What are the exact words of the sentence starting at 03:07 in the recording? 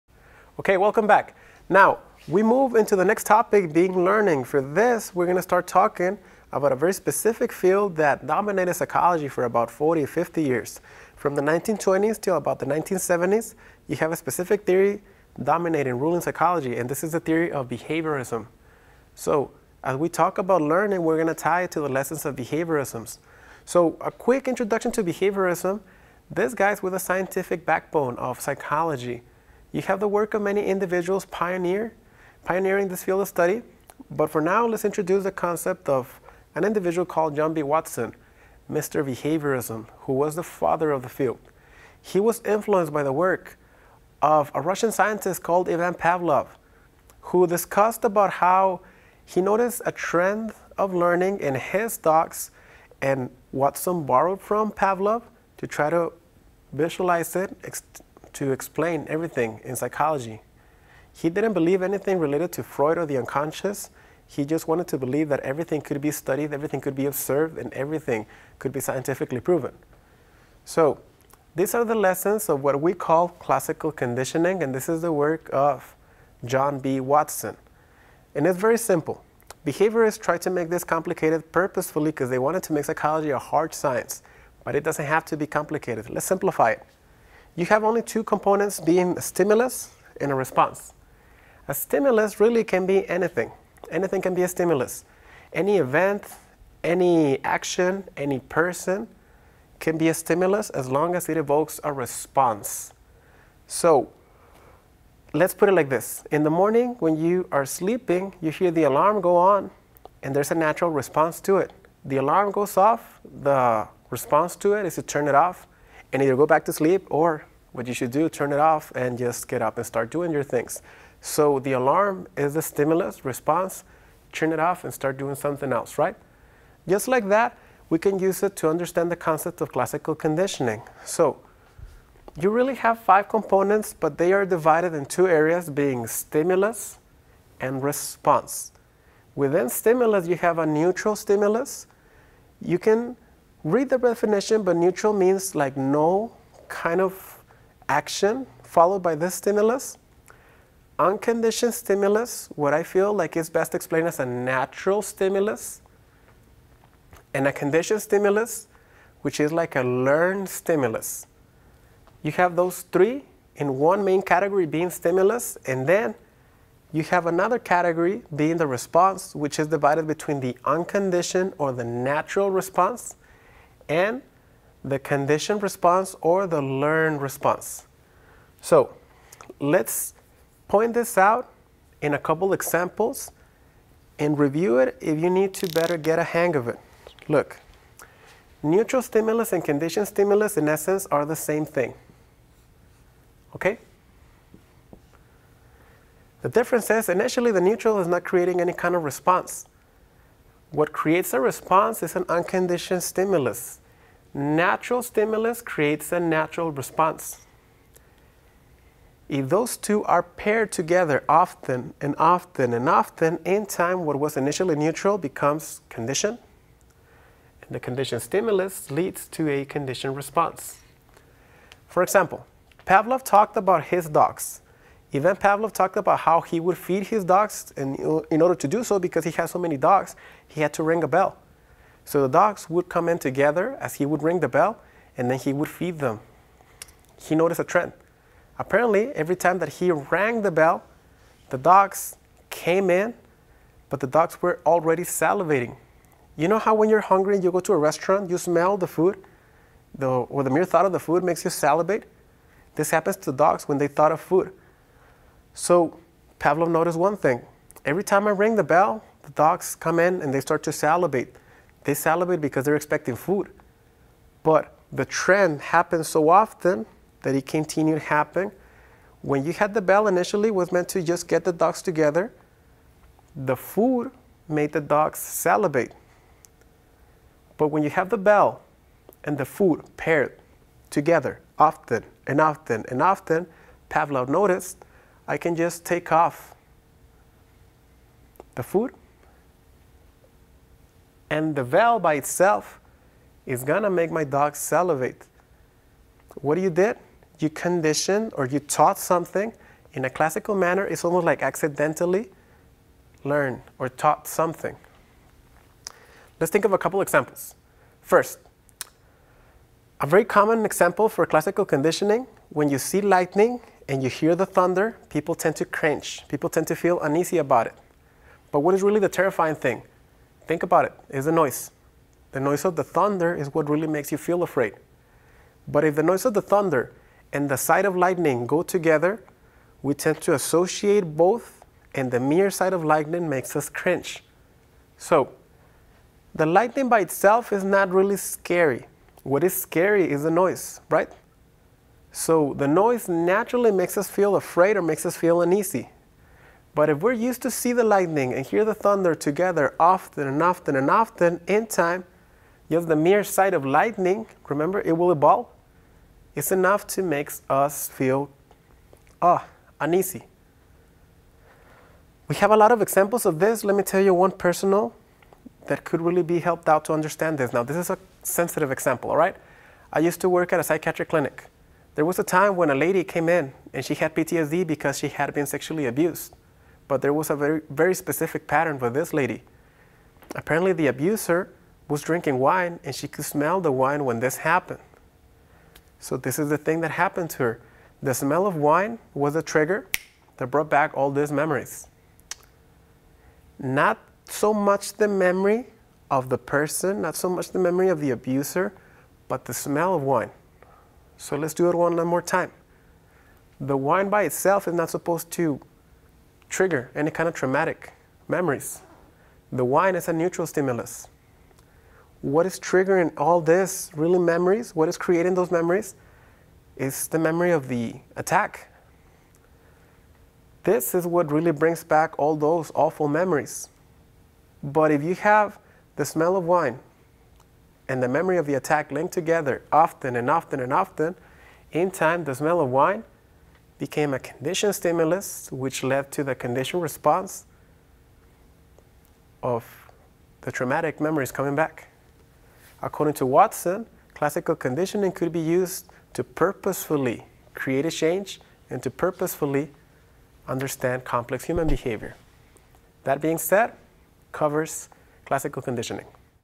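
Look, neutral stimulus and conditioned stimulus in essence are the same thing.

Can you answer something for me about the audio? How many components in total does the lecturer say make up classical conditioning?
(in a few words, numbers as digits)
5.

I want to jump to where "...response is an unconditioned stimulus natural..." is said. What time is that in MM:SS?
03:21.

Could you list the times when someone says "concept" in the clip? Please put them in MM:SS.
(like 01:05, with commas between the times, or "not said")
00:35, 02:09.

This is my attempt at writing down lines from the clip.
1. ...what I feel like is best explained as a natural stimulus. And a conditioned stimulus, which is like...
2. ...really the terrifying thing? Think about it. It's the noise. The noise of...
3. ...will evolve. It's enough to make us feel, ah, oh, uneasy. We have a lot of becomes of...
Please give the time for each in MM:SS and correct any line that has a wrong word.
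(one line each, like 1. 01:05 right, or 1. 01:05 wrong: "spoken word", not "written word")
1. 02:32 right
2. 05:18 right
3. 05:54 wrong: "examples", not "becomes".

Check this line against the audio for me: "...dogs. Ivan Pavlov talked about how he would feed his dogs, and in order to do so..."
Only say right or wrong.
right.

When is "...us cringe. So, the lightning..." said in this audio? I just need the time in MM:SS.
05:33.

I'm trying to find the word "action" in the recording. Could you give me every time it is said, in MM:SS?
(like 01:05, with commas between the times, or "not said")
01:37, 02:27.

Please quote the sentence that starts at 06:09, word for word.
I used to work at a psychiatric clinic.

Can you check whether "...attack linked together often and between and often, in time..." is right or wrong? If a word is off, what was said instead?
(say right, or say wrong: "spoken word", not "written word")
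wrong: "often", not "between".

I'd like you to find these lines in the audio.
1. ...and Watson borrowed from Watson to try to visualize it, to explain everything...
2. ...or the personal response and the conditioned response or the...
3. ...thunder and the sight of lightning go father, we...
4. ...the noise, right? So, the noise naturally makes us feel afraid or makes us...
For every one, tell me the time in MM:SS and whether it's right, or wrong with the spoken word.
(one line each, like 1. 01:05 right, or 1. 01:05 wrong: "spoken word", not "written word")
1. 00:53 wrong: "Pavlov", not "Watson"
2. 02:51 wrong: "natural", not "personal"
3. 05:26 wrong: "together", not "father"
4. 05:40 right.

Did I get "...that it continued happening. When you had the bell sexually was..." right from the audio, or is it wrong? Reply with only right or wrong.
wrong.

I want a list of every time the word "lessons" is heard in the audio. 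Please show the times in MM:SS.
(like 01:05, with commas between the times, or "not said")
00:21, 01:11.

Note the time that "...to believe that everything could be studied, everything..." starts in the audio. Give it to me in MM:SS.
01:04.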